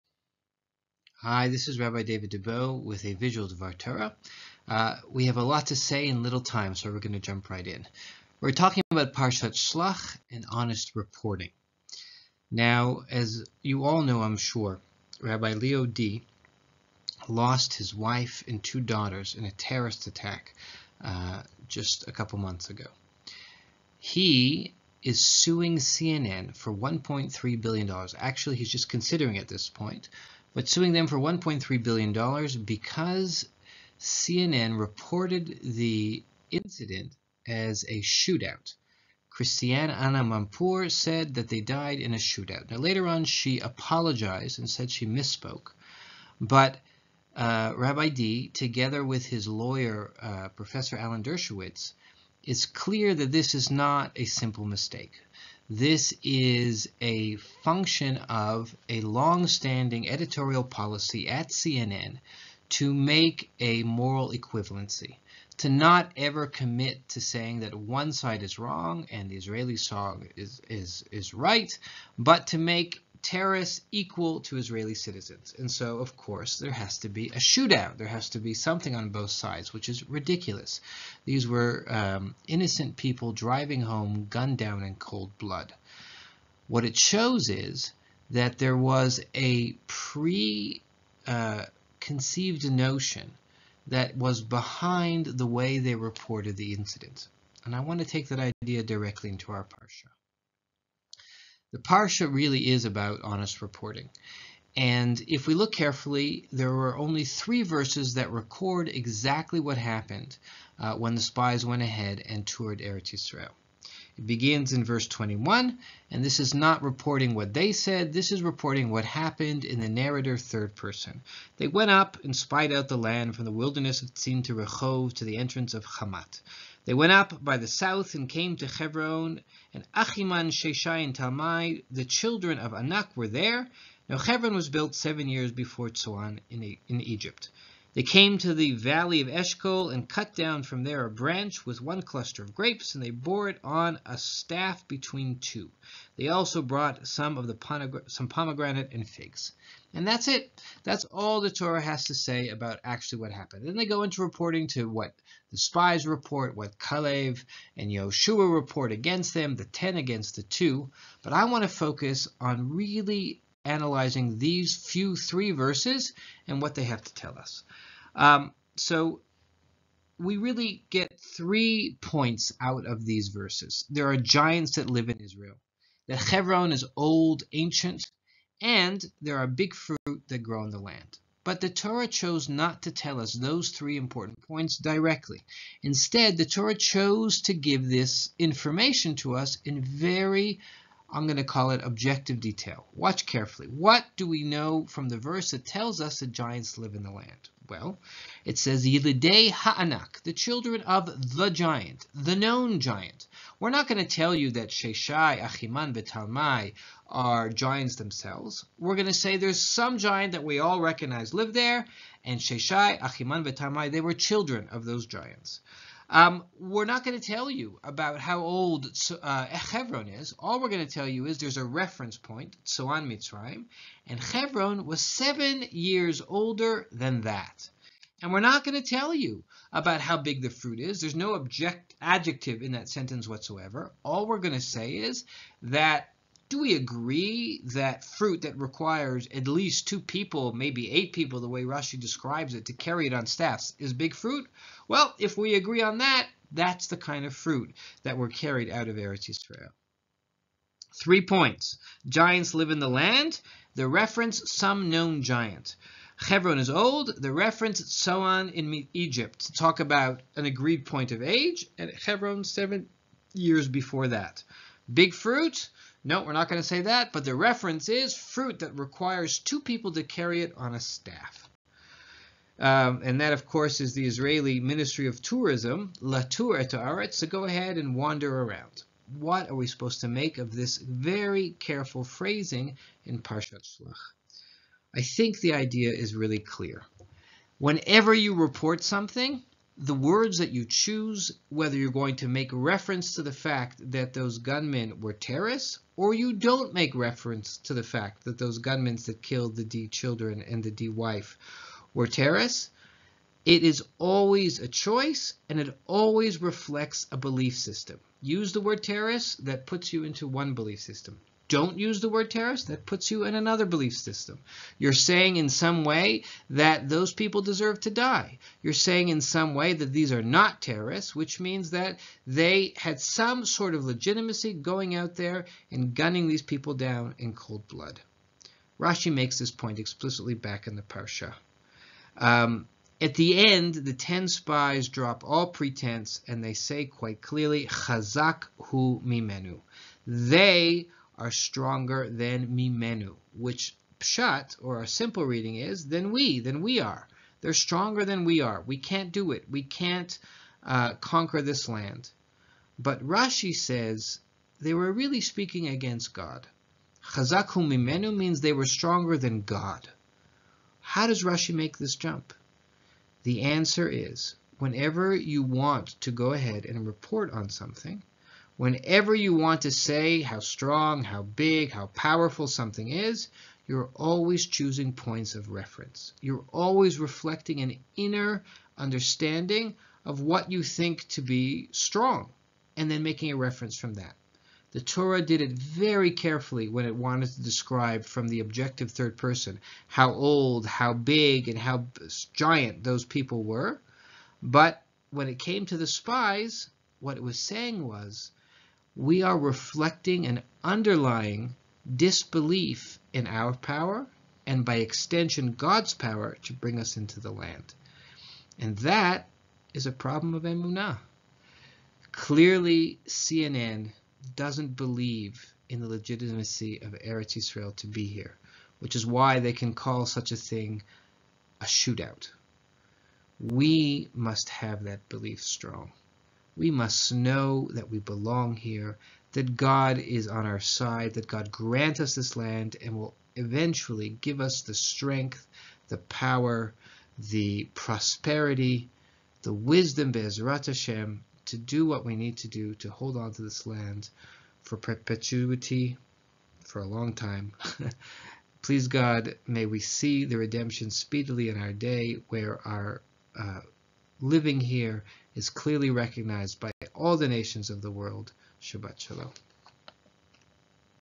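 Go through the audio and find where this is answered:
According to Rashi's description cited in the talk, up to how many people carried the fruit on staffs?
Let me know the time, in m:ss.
4:00.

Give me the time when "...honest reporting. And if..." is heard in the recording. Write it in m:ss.
1:43.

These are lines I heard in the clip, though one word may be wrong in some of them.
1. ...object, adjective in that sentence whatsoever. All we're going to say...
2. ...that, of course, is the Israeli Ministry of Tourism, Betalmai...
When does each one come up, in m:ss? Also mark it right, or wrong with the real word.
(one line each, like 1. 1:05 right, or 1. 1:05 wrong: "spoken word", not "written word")
1. 3:51 right
2. 4:33 wrong: "Latour", not "Betalmai".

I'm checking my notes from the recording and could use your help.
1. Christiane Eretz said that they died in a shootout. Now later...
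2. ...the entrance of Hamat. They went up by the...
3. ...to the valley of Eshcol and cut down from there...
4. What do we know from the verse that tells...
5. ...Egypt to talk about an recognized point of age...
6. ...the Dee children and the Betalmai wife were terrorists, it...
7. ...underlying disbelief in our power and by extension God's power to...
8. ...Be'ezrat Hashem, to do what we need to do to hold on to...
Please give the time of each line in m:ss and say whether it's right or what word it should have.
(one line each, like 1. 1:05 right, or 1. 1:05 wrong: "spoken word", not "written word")
1. 0:39 wrong: "Amanpour", not "Eretz"
2. 2:05 right
3. 2:18 right
4. 3:13 right
5. 4:18 wrong: "agreed", not "recognized"
6. 4:59 wrong: "Dee", not "Betalmai"
7. 6:40 right
8. 7:20 right.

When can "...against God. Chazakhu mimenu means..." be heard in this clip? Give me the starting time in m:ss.
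5:55.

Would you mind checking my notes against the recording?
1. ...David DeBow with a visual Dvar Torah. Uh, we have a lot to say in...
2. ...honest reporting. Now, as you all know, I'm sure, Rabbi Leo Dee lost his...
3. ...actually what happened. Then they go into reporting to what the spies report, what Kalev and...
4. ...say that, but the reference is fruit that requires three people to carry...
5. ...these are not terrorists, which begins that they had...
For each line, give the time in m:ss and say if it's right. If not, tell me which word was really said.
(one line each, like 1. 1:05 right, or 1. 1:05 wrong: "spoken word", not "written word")
1. 0:02 right
2. 0:10 right
3. 2:32 right
4. 4:26 wrong: "two", not "three"
5. 5:19 wrong: "means", not "begins".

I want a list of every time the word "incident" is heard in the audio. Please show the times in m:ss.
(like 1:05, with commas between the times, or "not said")
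0:36, 1:36.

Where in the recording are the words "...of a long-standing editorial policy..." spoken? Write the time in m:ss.
0:58.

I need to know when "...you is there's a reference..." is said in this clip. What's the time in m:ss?
3:41.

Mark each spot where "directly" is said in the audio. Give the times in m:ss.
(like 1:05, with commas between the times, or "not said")
1:38, 3:04.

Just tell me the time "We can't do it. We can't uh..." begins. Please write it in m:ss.
5:48.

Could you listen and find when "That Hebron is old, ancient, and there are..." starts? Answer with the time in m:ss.
2:56.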